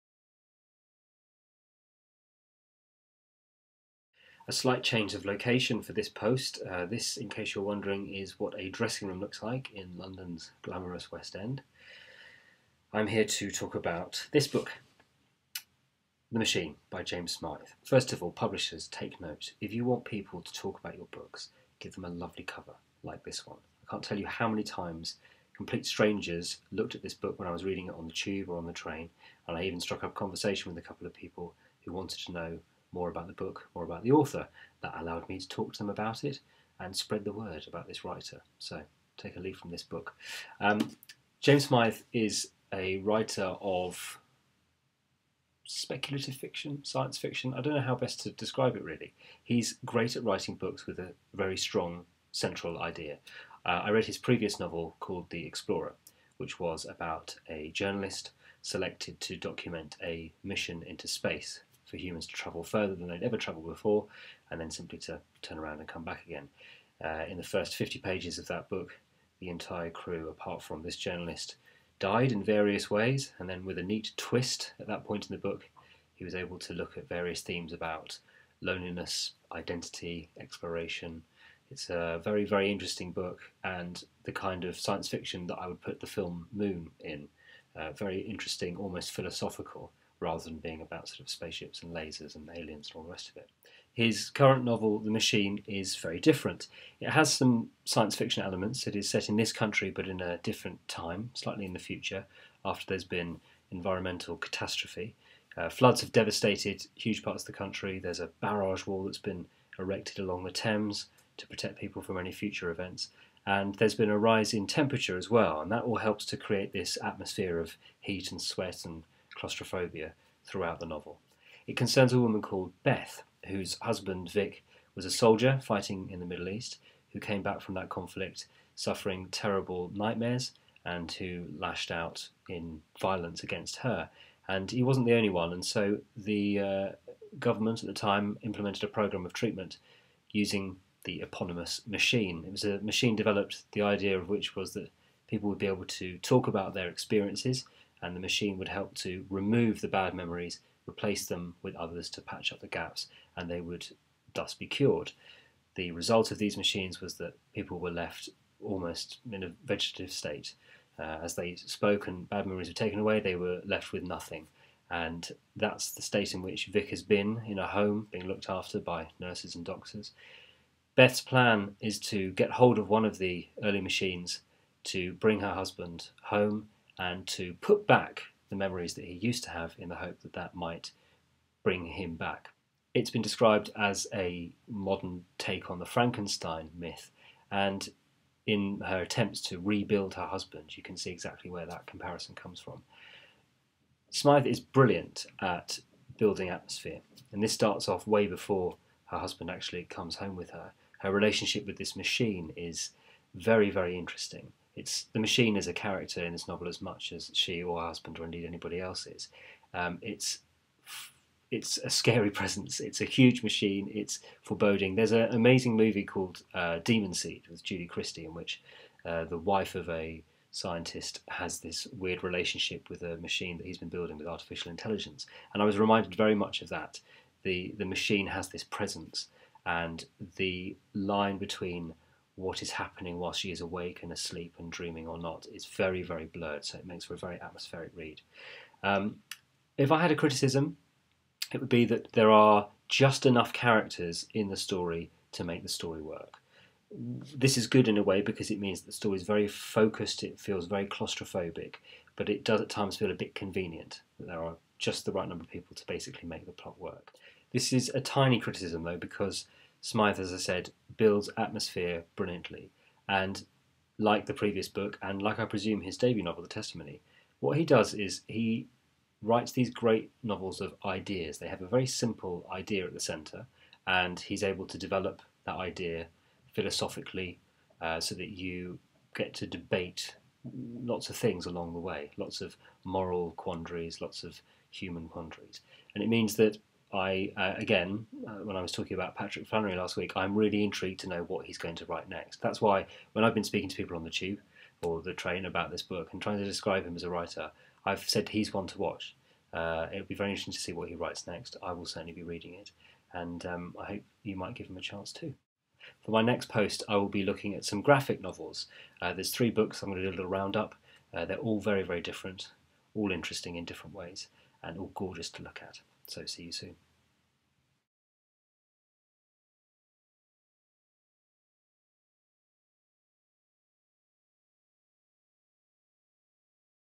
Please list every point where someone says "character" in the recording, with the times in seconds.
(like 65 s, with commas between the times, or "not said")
205 s, 243 s.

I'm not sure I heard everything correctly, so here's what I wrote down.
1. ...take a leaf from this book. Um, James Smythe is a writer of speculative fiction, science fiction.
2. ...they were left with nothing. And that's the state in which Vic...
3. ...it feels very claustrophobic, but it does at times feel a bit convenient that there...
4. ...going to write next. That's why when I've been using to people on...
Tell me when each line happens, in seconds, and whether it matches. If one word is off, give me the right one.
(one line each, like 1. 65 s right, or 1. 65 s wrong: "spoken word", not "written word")
1. 39 s right
2. 163 s right
3. 250 s right
4. 291 s wrong: "speaking", not "using".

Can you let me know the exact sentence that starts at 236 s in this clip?
So it makes for a very atmospheric read.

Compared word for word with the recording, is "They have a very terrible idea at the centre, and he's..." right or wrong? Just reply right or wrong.
wrong.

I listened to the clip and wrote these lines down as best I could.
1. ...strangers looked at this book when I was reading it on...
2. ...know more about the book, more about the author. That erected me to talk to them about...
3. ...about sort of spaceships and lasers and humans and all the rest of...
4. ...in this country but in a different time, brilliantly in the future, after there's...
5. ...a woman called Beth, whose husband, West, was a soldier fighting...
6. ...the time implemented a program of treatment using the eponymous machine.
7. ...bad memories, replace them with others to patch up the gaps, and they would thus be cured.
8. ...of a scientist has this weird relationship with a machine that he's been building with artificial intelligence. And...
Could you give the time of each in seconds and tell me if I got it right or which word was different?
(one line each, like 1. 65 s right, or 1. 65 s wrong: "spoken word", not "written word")
1. 25 s right
2. 32 s wrong: "allowed", not "erected"
3. 90 s wrong: "aliens", not "humans"
4. 99 s wrong: "slightly", not "brilliantly"
5. 122 s wrong: "Vic", not "West"
6. 137 s right
7. 149 s right
8. 219 s right.